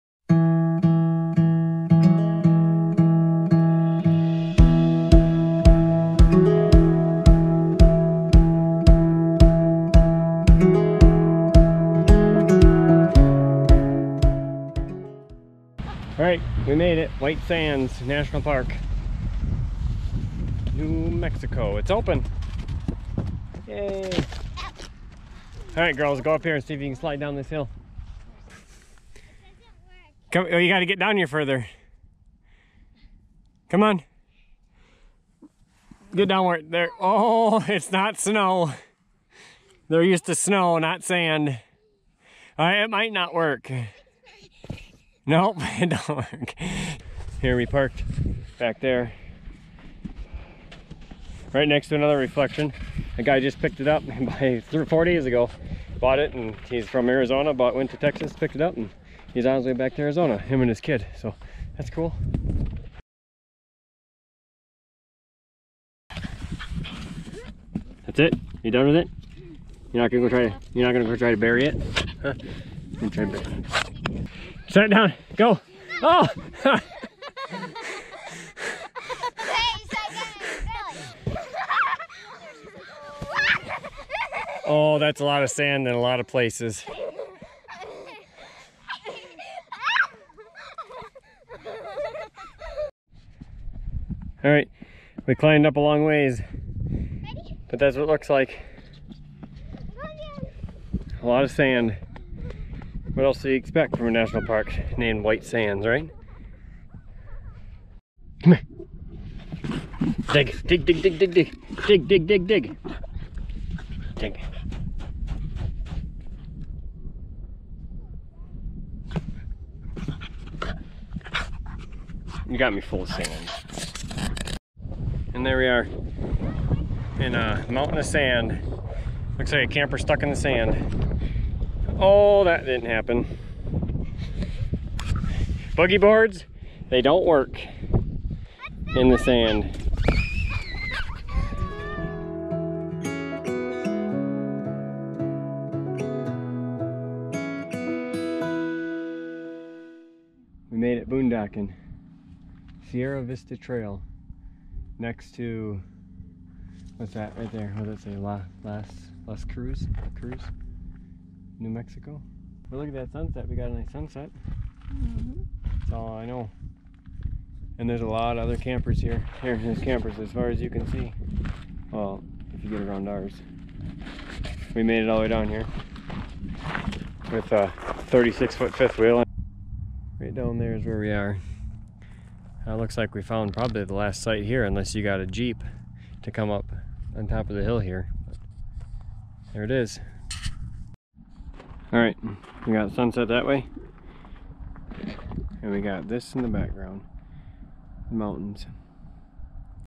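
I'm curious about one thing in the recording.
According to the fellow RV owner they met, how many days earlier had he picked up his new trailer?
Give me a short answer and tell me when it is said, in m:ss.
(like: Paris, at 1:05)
4, at 0:54.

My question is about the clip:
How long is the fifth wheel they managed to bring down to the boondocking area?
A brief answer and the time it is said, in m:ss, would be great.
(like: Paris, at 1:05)
36 feet, at 2:58.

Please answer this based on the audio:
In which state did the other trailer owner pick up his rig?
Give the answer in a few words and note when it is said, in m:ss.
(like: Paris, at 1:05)
Texas, at 0:57.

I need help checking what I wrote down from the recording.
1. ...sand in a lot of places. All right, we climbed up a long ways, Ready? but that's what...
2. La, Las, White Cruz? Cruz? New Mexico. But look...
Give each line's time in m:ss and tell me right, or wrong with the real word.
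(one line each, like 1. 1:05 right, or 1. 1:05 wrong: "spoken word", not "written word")
1. 1:25 right
2. 2:38 wrong: "Las", not "White".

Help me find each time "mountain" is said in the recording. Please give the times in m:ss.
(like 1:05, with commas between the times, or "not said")
2:07, 3:18.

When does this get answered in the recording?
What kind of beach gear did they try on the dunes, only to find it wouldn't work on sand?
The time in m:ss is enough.
2:15.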